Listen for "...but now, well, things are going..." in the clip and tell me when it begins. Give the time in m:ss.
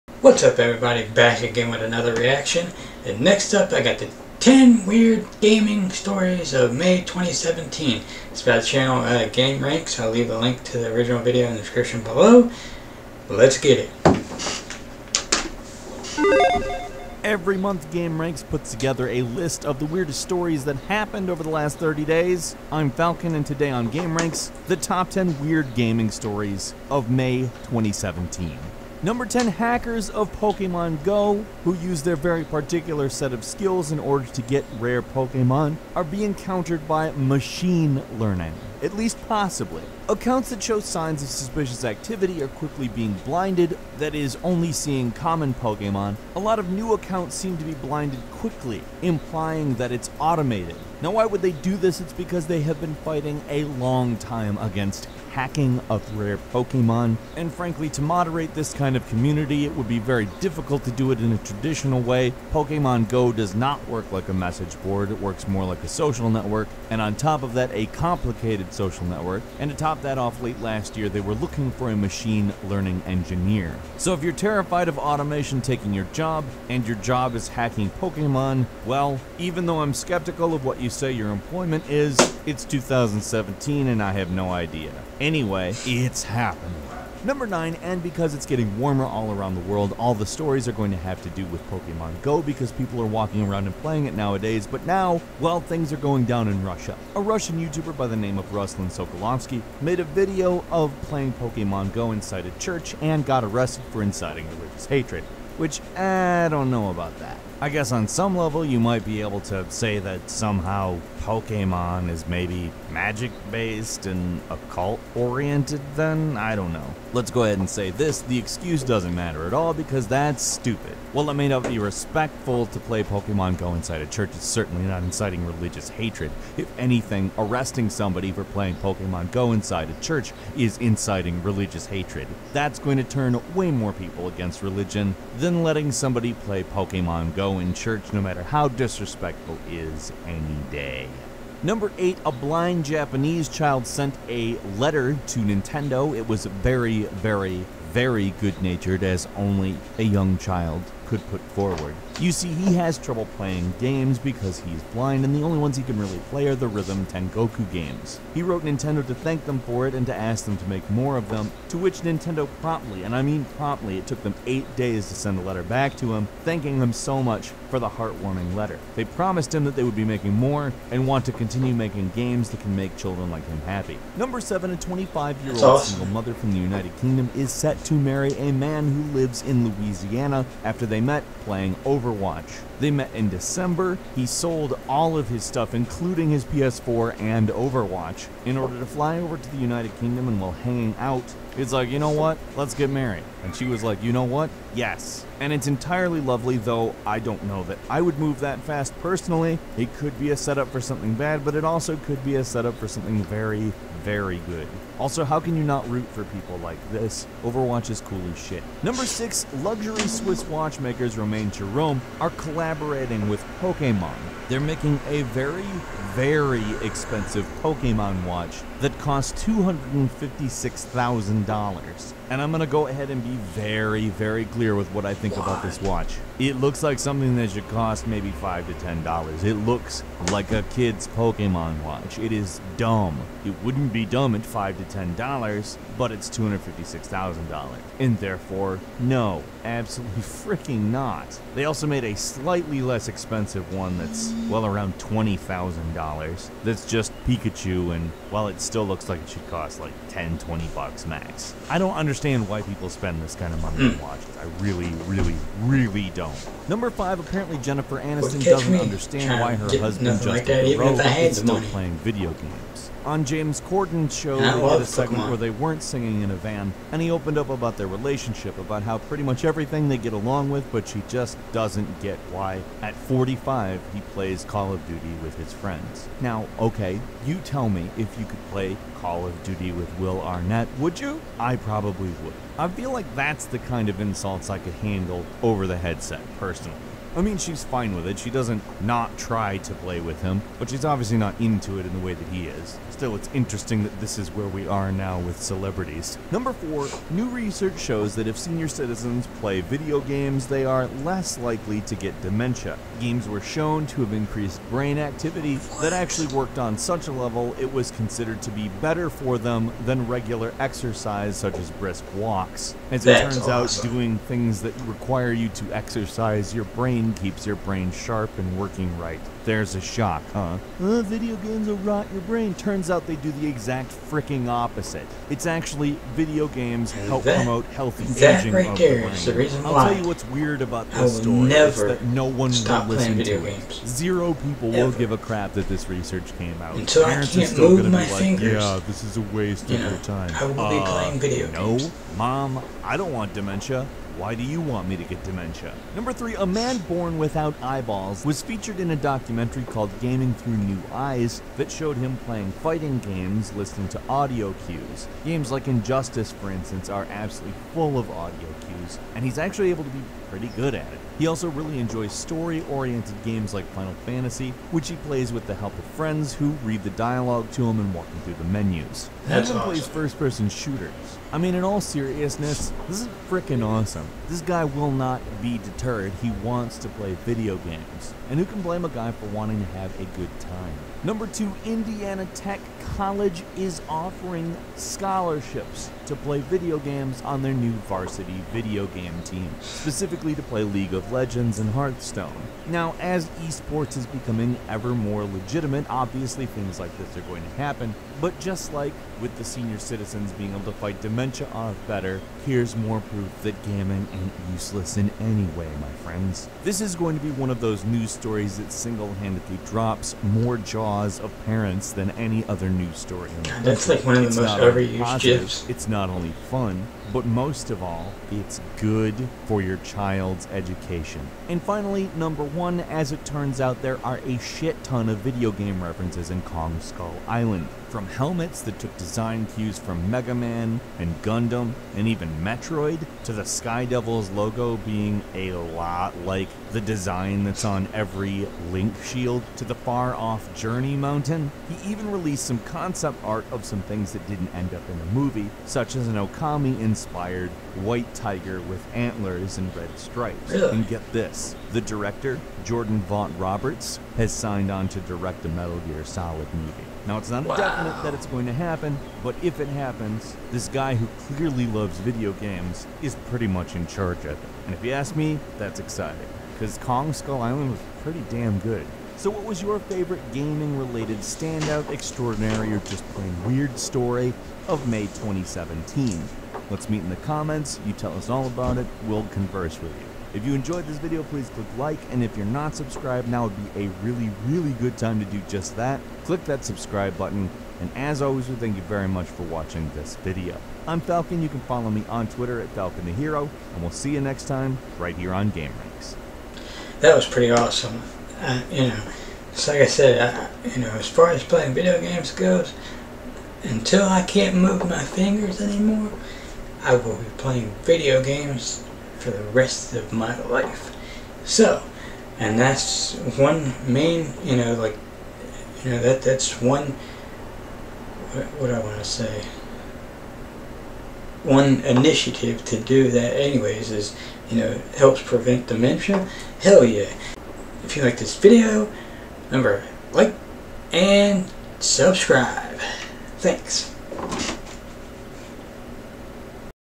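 1:34.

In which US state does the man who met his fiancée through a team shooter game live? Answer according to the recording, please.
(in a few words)
Louisiana.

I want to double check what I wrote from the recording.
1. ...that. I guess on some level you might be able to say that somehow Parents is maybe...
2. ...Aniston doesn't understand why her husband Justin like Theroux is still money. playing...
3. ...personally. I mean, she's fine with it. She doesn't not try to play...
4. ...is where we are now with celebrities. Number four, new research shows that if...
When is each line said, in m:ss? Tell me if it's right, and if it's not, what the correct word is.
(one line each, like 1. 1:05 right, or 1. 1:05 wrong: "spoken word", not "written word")
1. 1:47 wrong: "Pokemon", not "Parents"
2. 4:18 right
3. 4:46 right
4. 4:54 right.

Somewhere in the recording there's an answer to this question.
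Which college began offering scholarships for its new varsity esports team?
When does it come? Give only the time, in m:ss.
6:21.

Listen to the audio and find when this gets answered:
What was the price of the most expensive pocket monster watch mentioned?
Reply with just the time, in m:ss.
3:39.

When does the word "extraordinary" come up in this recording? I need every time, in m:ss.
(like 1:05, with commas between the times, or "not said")
7:51.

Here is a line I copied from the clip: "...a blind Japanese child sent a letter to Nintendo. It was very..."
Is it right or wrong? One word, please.
right.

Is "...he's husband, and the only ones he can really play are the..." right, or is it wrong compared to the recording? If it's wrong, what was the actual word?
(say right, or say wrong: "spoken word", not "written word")
wrong: "blind", not "husband".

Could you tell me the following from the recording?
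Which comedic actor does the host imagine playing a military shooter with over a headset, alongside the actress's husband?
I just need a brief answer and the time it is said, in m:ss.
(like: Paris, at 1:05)
Will Arnett, at 4:39.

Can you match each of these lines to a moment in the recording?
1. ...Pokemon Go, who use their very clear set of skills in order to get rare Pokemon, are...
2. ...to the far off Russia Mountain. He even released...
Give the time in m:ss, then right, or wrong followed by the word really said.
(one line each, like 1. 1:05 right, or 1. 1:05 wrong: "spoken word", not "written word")
1. 0:30 wrong: "particular", not "clear"
2. 7:19 wrong: "Journey", not "Russia".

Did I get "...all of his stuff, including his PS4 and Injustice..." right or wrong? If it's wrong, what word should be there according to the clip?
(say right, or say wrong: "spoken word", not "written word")
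wrong: "Overwatch", not "Injustice".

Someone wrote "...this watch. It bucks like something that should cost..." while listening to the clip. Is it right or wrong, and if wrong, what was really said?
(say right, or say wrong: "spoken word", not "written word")
wrong: "looks", not "bucks".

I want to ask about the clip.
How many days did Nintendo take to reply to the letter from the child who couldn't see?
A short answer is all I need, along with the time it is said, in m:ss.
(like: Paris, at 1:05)
8, at 2:44.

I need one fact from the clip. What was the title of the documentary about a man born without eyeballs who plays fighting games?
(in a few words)
Gaming Through New Eyes.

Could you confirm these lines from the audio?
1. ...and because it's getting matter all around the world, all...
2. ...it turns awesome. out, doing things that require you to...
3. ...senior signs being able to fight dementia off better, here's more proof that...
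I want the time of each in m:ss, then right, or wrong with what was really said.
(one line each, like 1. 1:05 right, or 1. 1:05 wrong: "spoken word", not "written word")
1. 1:27 wrong: "warmer", not "matter"
2. 5:13 right
3. 6:39 wrong: "citizens", not "signs".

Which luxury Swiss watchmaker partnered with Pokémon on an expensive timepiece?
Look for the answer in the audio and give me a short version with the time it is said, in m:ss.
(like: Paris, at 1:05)
Romain Jerome, at 3:31.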